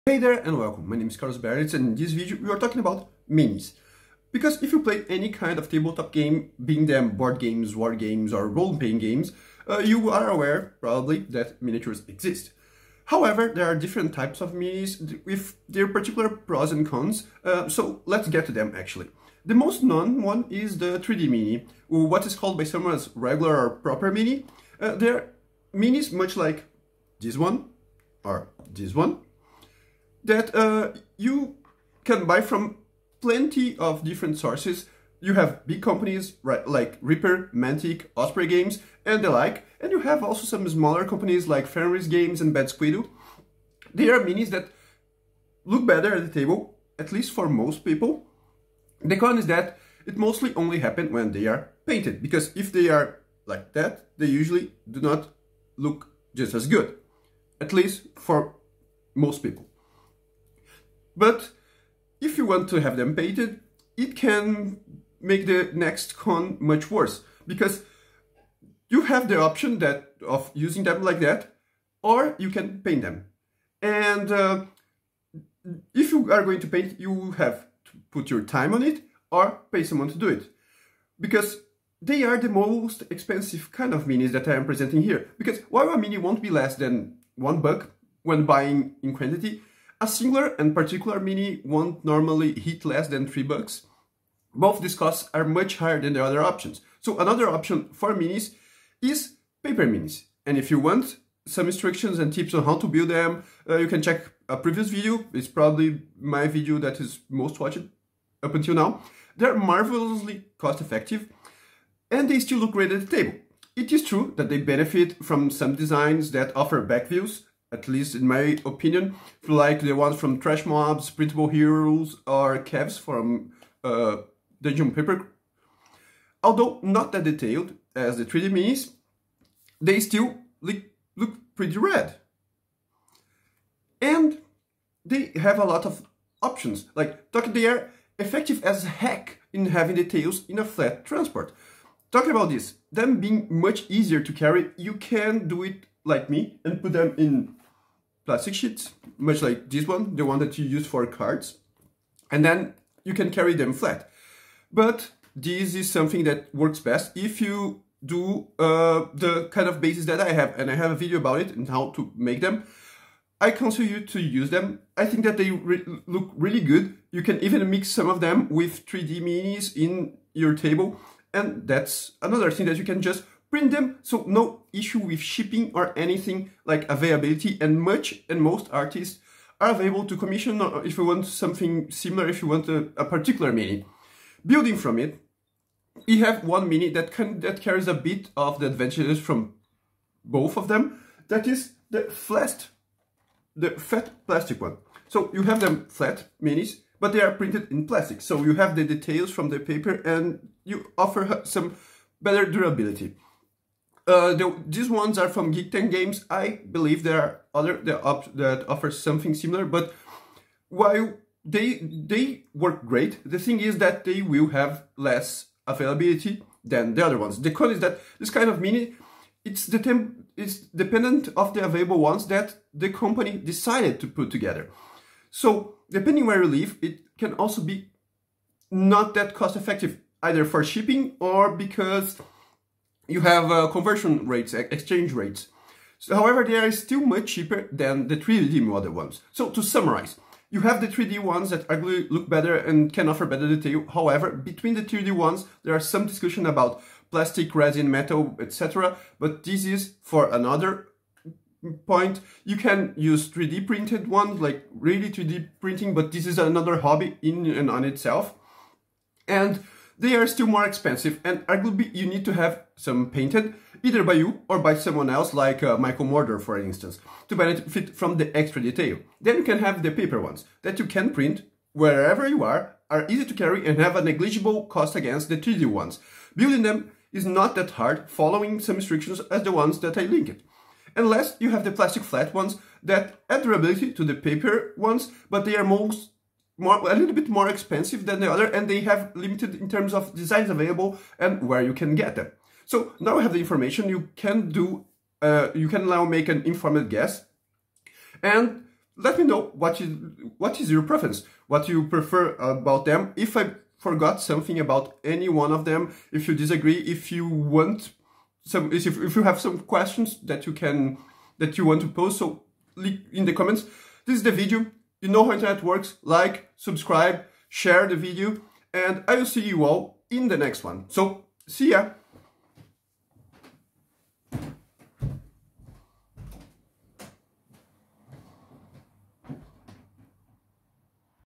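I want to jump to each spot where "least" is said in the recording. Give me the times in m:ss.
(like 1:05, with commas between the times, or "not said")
0:47, 0:57, 1:57.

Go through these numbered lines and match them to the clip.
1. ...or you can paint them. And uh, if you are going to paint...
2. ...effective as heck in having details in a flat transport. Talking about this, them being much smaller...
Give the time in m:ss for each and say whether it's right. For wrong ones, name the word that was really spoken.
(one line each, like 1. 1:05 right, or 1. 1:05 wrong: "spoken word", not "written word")
1. 1:12 right
2. 2:18 wrong: "easier", not "smaller".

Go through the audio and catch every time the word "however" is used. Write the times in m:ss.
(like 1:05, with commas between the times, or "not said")
0:13, 3:56, 4:03.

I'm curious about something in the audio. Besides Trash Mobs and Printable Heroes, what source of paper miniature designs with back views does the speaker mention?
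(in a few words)
Dungeon Paper.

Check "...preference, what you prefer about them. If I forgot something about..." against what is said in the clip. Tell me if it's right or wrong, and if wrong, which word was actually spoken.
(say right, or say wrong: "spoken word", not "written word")
right.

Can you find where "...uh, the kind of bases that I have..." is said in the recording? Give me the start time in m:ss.
2:38.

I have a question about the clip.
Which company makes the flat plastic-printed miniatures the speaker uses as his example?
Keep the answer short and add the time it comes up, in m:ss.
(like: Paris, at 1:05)
Geek Ten Games, at 3:25.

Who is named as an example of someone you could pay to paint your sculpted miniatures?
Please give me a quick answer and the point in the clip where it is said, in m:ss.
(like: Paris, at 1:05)
Michael Mordor, at 4:25.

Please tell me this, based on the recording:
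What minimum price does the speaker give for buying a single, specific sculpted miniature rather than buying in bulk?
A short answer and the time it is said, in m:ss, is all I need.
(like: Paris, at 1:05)
3 bucks, at 1:33.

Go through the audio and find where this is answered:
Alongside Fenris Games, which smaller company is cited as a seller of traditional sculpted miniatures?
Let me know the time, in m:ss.
0:42.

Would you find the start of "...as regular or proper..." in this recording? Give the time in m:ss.
0:22.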